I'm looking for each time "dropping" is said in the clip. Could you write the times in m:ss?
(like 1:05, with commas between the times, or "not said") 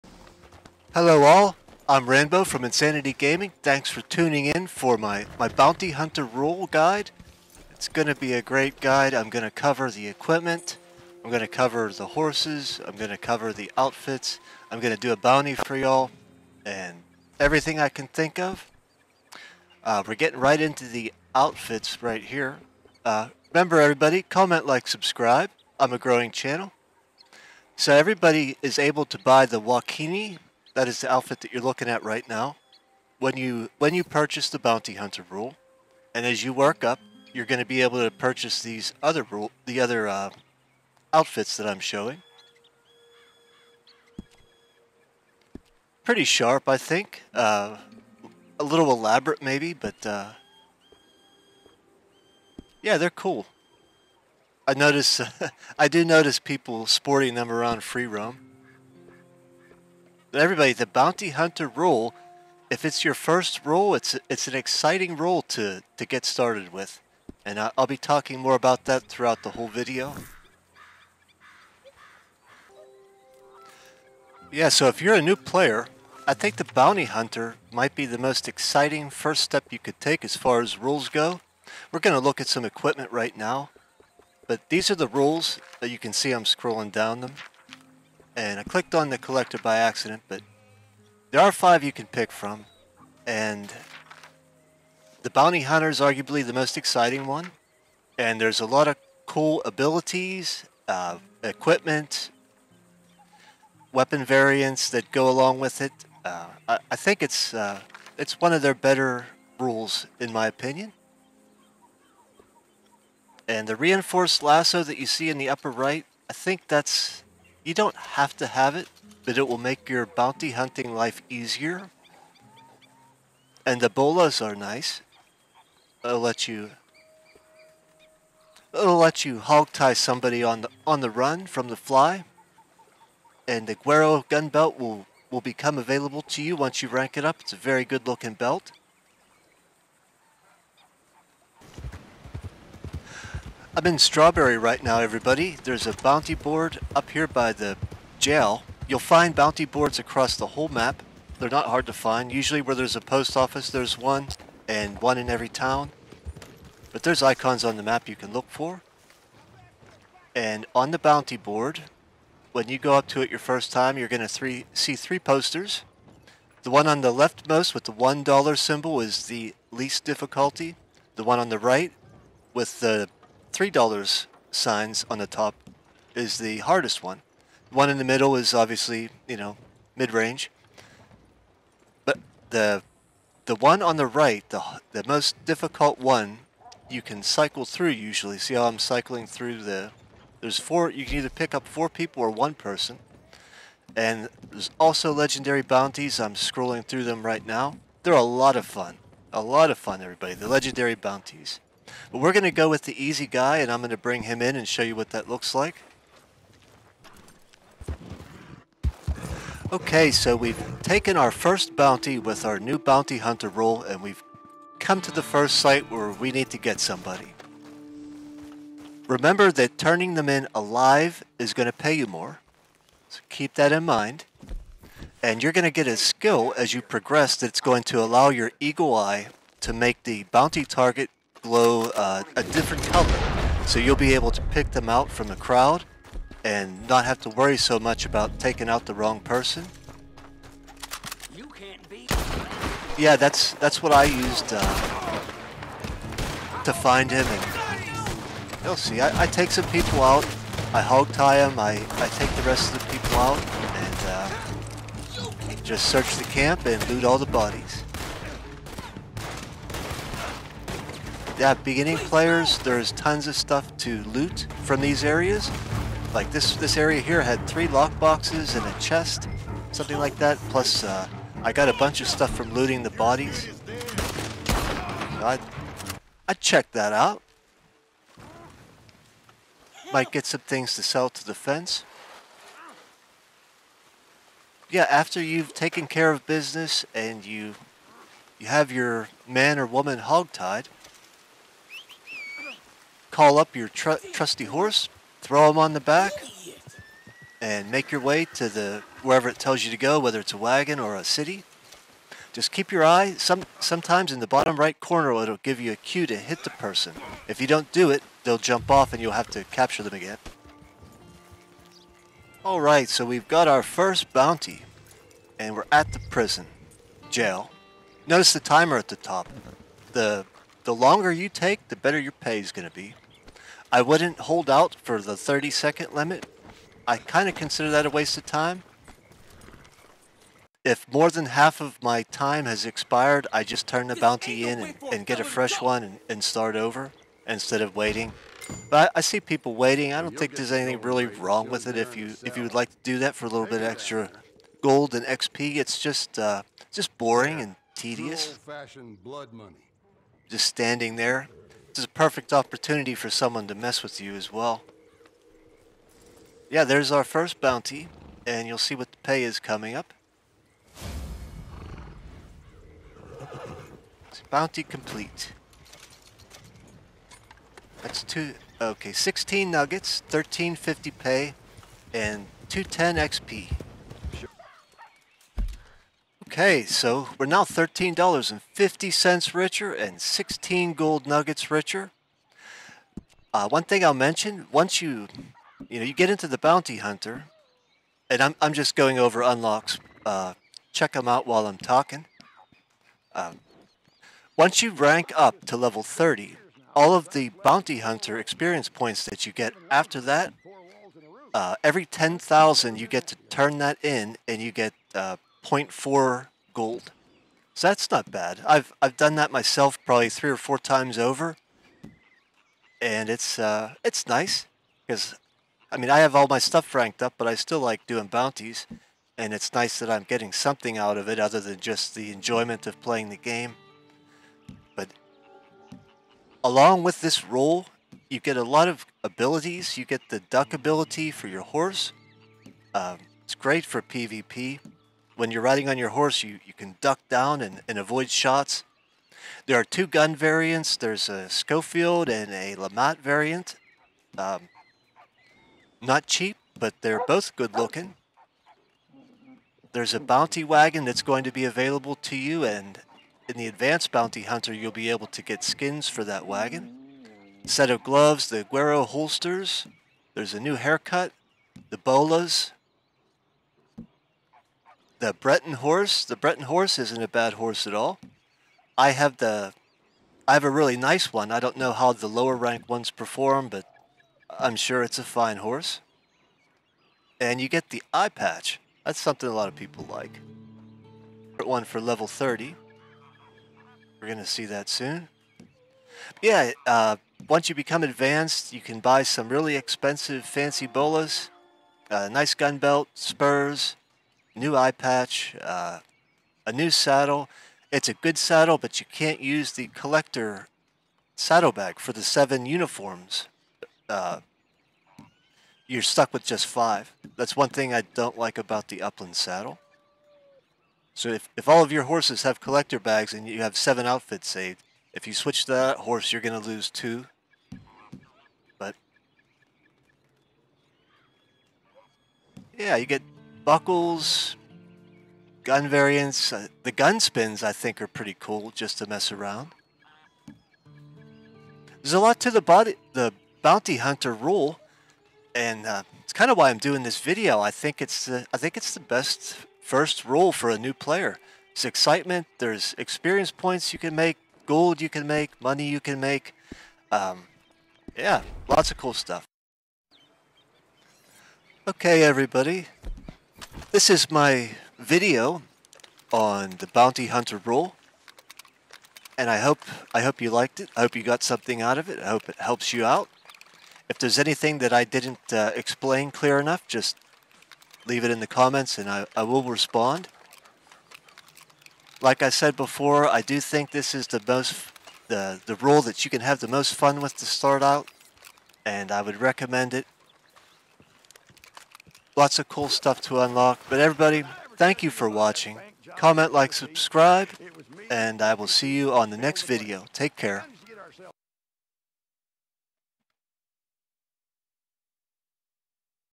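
not said.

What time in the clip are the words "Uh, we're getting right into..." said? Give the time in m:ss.
0:19.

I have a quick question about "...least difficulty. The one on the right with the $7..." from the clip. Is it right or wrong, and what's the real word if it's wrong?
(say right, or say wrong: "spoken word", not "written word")
wrong: "3", not "7".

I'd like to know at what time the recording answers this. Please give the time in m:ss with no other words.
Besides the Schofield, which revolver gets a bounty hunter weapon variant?
7:22.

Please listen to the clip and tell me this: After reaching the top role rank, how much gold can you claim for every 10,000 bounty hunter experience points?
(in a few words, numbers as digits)
0.4 gold.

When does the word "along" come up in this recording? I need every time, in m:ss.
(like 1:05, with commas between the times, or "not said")
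1:45, 7:06.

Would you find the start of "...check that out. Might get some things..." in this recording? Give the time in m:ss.
4:36.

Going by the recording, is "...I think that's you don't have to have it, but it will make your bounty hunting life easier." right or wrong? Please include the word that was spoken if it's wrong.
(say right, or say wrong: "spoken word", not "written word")
right.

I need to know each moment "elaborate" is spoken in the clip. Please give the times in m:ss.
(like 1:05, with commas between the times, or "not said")
0:48.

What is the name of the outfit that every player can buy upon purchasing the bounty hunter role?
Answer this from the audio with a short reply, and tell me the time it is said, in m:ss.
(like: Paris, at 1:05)
Wakini, at 0:29.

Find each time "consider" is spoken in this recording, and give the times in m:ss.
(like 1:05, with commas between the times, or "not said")
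5:27.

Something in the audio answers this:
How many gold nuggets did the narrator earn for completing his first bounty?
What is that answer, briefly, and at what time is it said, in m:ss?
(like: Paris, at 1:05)
16, at 6:08.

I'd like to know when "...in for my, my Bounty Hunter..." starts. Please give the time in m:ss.
0:04.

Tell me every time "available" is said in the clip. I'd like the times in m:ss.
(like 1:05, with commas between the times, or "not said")
2:15, 7:31.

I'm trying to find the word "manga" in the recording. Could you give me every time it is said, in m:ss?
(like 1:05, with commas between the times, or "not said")
not said.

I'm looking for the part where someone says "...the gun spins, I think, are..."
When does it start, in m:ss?
8:46.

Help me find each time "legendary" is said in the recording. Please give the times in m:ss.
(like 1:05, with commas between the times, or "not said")
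3:15, 3:20.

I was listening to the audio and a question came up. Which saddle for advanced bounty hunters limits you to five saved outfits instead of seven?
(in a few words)
Upland saddle.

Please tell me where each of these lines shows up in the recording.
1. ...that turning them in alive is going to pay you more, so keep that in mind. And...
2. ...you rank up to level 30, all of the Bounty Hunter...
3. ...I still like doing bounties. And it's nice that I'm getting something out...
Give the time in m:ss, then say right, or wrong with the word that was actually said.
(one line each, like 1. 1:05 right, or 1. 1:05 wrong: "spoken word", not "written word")
1. 3:39 right
2. 6:34 right
3. 6:57 right.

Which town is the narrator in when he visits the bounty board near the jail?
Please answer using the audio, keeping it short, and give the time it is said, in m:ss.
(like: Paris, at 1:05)
Strawberry, at 2:23.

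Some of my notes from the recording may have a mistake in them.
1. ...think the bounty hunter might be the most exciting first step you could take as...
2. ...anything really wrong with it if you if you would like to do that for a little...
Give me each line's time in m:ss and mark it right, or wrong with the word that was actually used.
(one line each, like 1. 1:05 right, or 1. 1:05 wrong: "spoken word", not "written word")
1. 1:16 right
2. 5:40 right.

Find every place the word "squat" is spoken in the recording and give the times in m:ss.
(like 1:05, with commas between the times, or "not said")
not said.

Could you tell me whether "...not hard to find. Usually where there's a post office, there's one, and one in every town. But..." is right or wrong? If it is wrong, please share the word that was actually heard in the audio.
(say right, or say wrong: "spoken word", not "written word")
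right.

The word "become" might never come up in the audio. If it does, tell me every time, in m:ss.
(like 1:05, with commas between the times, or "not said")
2:15, 8:07.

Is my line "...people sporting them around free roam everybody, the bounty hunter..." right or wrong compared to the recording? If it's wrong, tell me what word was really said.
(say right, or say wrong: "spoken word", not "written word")
right.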